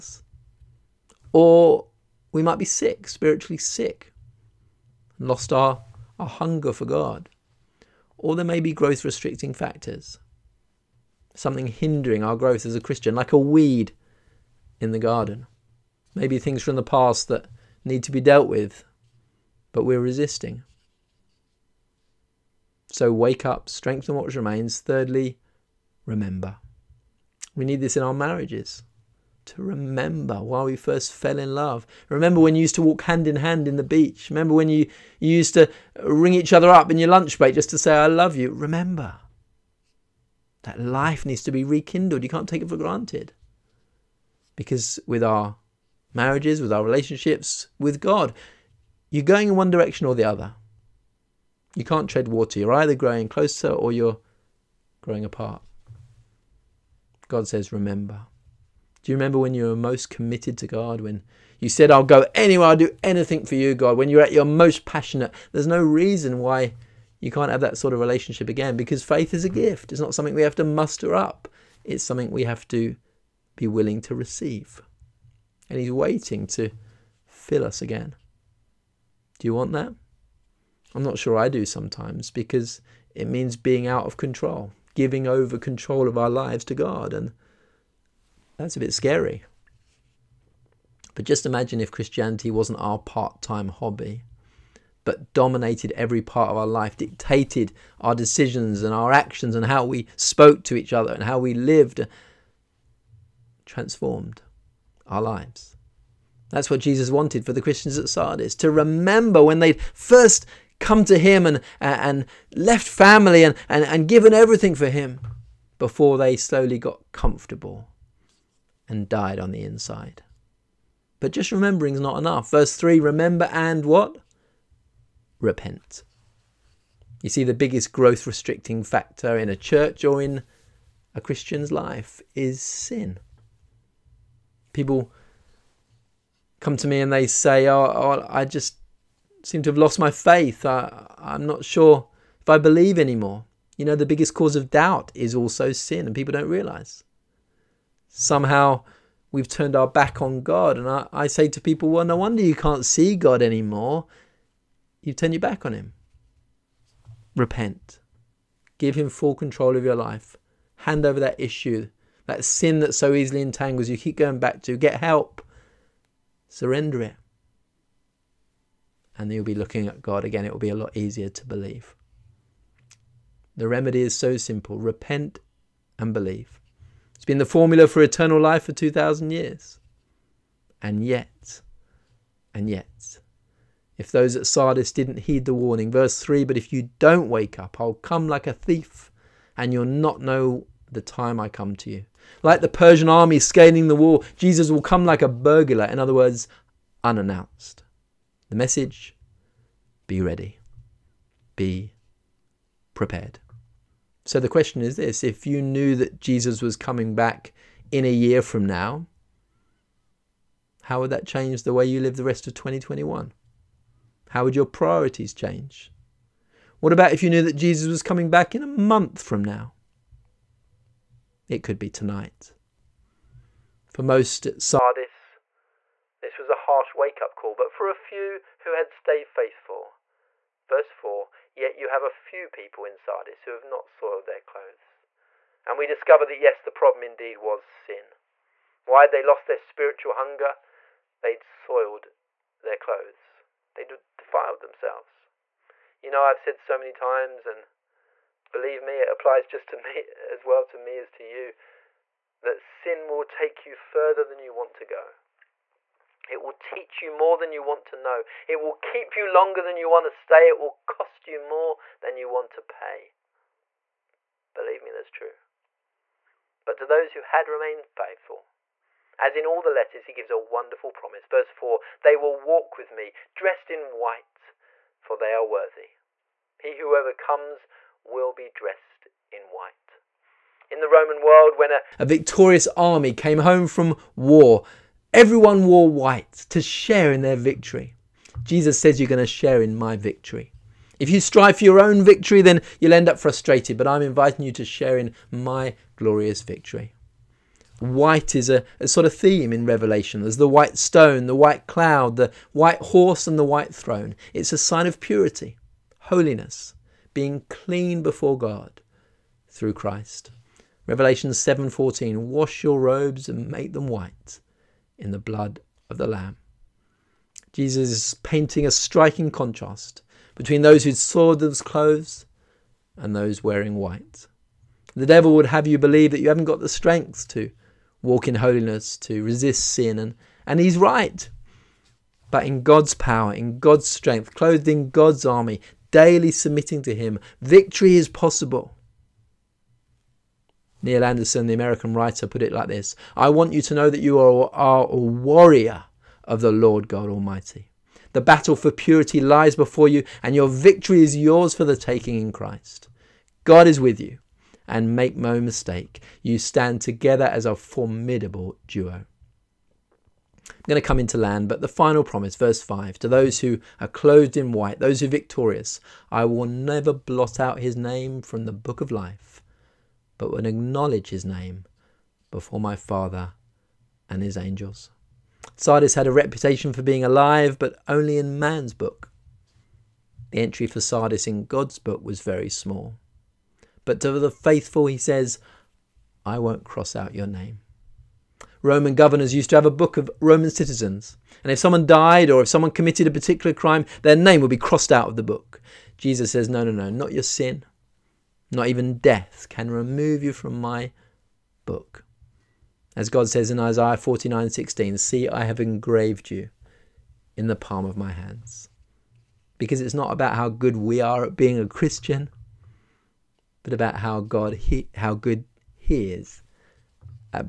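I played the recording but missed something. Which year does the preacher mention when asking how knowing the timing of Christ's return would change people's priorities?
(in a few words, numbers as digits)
2021.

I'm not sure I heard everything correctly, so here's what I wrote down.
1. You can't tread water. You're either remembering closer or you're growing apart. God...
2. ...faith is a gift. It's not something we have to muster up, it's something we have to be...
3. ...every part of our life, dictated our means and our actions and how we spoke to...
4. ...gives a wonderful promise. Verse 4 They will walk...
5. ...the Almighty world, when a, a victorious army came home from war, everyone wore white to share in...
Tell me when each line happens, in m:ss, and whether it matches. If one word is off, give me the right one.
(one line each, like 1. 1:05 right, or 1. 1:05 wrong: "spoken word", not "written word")
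1. 0:51 wrong: "growing", not "remembering"
2. 1:09 right
3. 1:35 wrong: "decisions", not "means"
4. 4:30 right
5. 4:40 wrong: "Roman", not "Almighty".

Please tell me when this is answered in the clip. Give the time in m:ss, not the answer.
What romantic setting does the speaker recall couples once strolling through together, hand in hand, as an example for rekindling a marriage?
0:33.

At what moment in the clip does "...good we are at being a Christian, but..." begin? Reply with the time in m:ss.
6:50.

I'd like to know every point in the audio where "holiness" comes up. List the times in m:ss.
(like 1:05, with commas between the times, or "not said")
5:05, 5:28.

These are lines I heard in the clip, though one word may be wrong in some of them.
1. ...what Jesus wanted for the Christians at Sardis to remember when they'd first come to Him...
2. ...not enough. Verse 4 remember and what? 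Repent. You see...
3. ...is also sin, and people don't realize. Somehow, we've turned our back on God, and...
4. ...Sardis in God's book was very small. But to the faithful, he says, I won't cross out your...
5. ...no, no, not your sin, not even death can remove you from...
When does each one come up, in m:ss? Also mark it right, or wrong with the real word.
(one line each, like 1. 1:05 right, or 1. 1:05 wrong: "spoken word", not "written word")
1. 1:46 right
2. 2:02 wrong: "3", not "4"
3. 2:25 right
4. 6:20 right
5. 6:36 right.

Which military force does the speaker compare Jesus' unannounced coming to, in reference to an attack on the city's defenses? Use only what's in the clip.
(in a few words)
The Persian army.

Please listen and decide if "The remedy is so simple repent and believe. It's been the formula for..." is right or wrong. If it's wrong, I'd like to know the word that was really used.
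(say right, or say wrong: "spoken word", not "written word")
right.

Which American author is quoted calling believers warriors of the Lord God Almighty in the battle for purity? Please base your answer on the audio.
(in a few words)
Neil Anderson.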